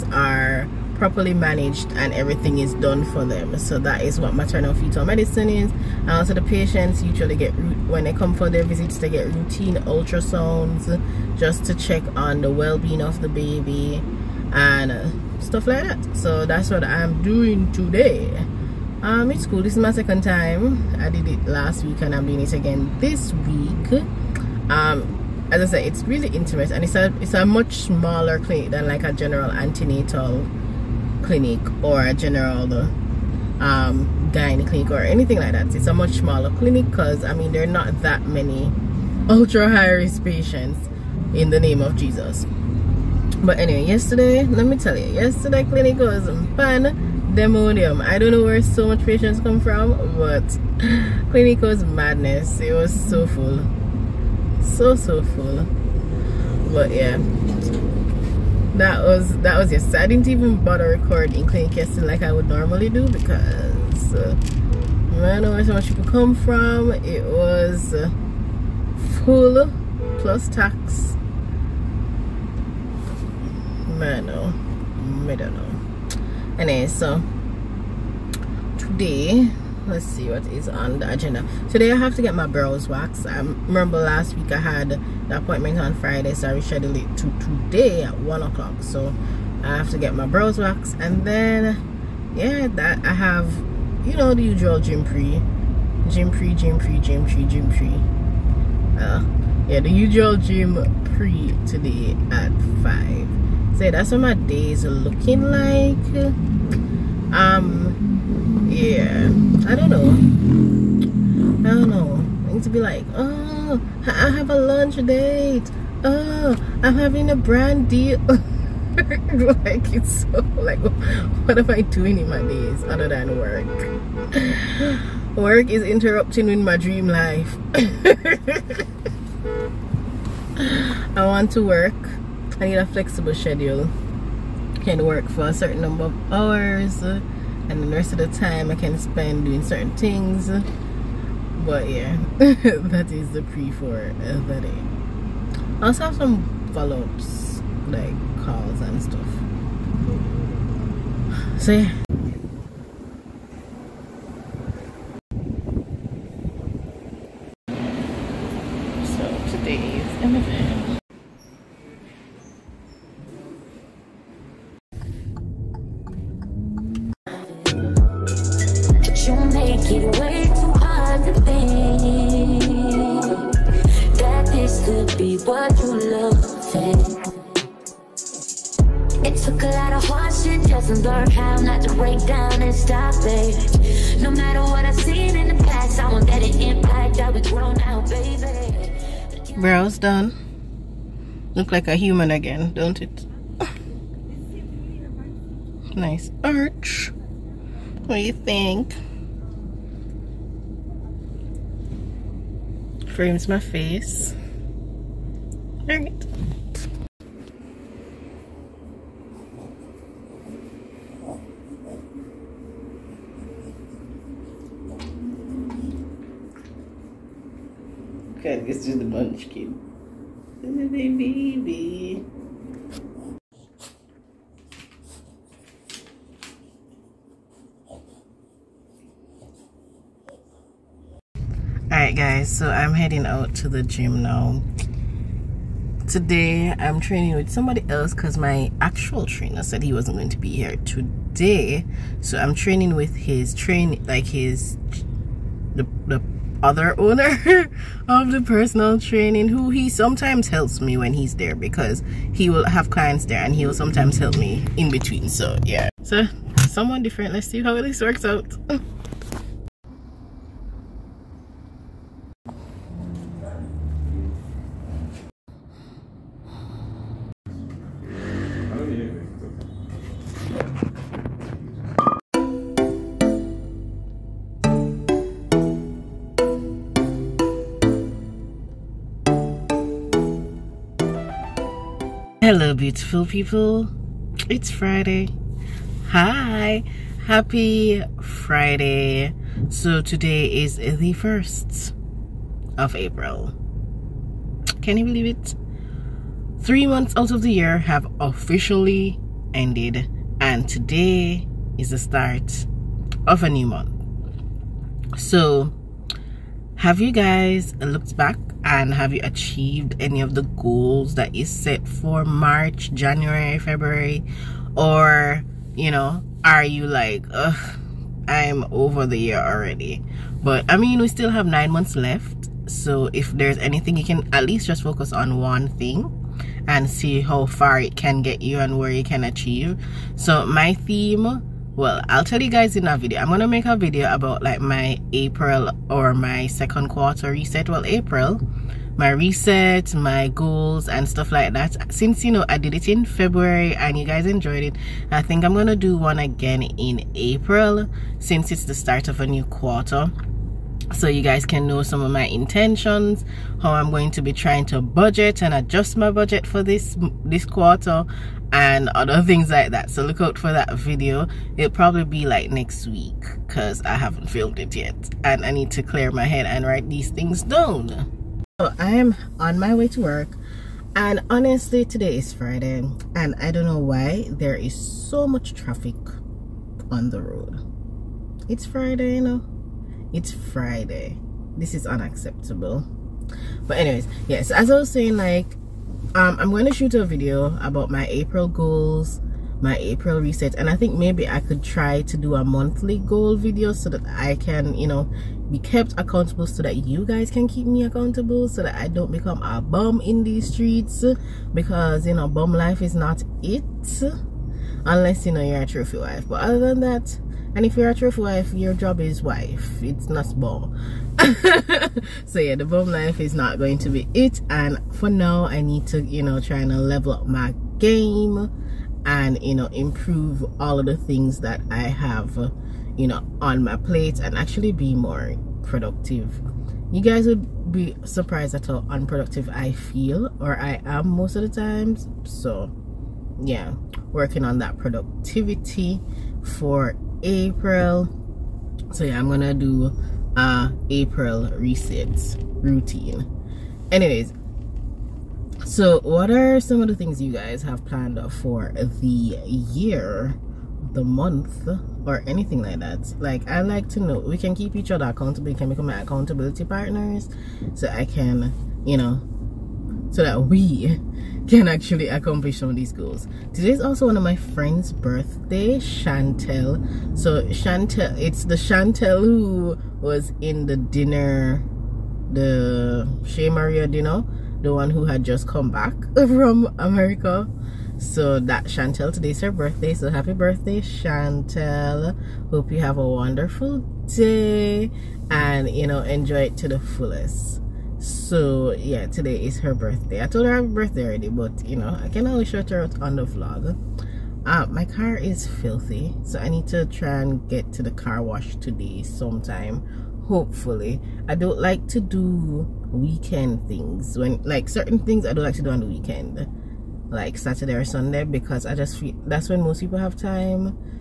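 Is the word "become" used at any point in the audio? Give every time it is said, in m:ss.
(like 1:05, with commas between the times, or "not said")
6:39, 7:35.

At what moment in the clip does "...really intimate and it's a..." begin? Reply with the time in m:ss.
0:26.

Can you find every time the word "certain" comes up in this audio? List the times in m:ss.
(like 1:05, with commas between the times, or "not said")
2:15, 2:19, 8:24.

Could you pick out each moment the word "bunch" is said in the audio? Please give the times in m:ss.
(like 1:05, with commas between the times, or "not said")
3:39.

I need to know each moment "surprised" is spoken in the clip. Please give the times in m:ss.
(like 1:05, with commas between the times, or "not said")
7:08.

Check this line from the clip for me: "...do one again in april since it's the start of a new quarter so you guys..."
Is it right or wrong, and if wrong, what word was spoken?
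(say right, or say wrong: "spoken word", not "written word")
right.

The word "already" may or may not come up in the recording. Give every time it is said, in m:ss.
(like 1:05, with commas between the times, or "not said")
5:19, 8:11.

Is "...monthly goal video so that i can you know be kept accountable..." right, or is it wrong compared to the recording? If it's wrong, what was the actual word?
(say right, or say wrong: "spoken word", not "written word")
right.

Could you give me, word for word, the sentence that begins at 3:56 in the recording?
Today I'm training with somebody else because my actual trainer said he wasn't going to be here today.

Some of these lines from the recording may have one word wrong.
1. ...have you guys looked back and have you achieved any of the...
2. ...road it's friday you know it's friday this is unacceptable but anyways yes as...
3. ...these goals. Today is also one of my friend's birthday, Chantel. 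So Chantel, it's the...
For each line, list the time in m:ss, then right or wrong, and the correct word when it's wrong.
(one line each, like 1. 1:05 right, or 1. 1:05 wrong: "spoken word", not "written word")
1. 5:06 right
2. 6:17 right
3. 7:42 right.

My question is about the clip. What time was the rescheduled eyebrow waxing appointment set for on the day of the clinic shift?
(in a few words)
1:00.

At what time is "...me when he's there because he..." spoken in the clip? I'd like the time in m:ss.
4:10.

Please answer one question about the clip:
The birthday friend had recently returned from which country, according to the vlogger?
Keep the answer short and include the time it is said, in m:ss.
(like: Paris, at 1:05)
America, at 7:56.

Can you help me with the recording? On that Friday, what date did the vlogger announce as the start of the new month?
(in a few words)
1st of April.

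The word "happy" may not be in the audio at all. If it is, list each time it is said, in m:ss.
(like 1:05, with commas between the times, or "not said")
4:47, 8:00, 8:10.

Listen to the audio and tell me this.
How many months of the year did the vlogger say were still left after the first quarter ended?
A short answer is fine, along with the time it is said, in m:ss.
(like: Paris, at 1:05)
9, at 5:21.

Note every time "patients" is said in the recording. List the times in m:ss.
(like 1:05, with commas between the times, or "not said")
0:06, 0:40, 0:49.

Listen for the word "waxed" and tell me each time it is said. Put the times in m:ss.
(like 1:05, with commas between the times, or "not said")
1:22, 1:30.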